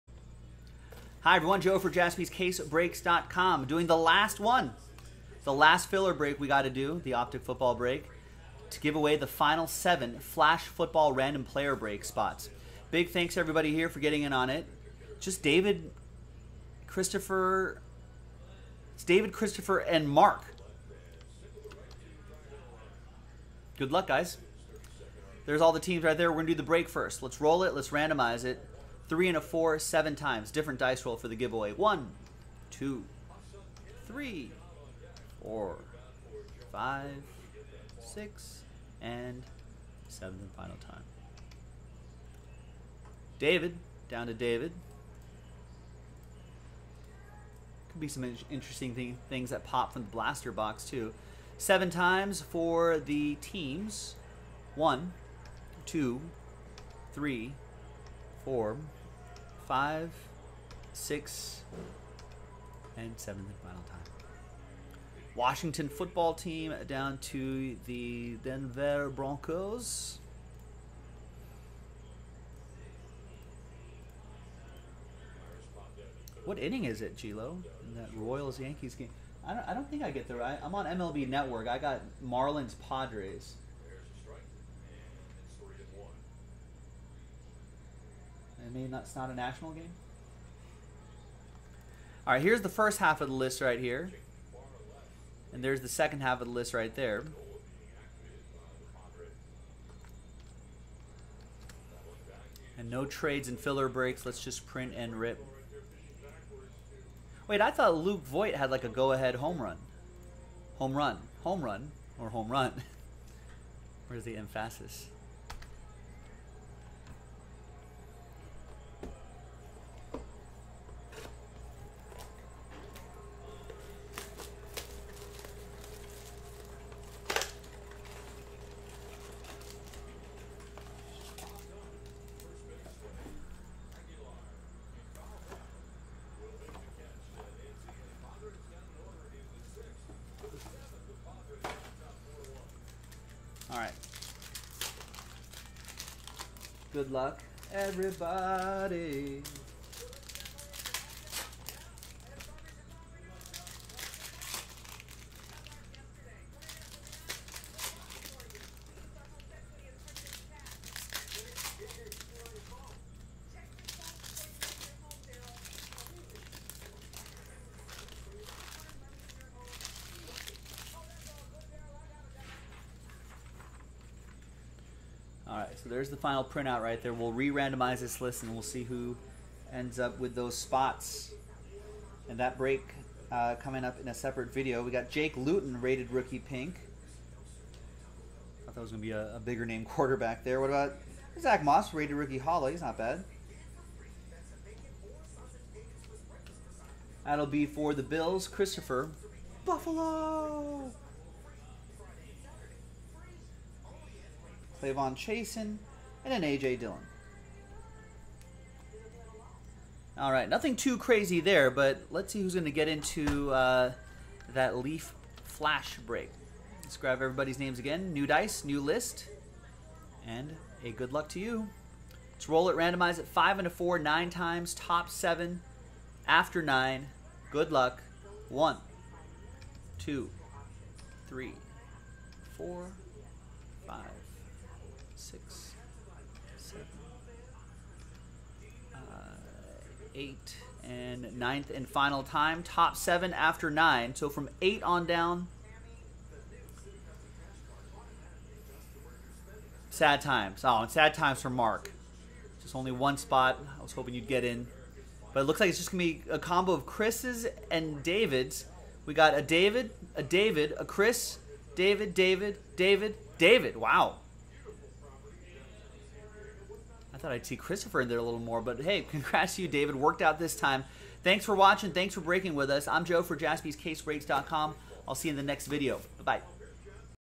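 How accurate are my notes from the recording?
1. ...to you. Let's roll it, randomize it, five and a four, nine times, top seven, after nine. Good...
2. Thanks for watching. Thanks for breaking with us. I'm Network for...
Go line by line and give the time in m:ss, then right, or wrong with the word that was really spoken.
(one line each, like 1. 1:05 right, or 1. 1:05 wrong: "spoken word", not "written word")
1. 3:41 right
2. 4:31 wrong: "Joe", not "Network".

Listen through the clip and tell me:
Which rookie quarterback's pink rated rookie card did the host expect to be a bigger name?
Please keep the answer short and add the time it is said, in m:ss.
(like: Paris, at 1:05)
Jake Luton, at 3:05.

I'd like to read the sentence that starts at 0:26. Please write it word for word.
We're going to do the break first.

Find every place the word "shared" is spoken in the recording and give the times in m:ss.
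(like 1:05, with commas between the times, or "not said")
not said.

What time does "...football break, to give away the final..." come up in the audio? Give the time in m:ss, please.
0:07.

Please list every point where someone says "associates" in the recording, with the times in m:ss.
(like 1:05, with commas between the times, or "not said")
not said.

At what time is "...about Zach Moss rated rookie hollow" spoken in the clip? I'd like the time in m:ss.
3:10.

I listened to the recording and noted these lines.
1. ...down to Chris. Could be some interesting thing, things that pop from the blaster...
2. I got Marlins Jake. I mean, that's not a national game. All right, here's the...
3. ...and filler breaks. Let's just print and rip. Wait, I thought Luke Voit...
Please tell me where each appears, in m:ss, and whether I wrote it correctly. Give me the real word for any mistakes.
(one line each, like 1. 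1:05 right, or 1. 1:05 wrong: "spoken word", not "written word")
1. 0:44 wrong: "David", not "Chris"
2. 1:21 wrong: "Padres", not "Jake"
3. 1:43 right.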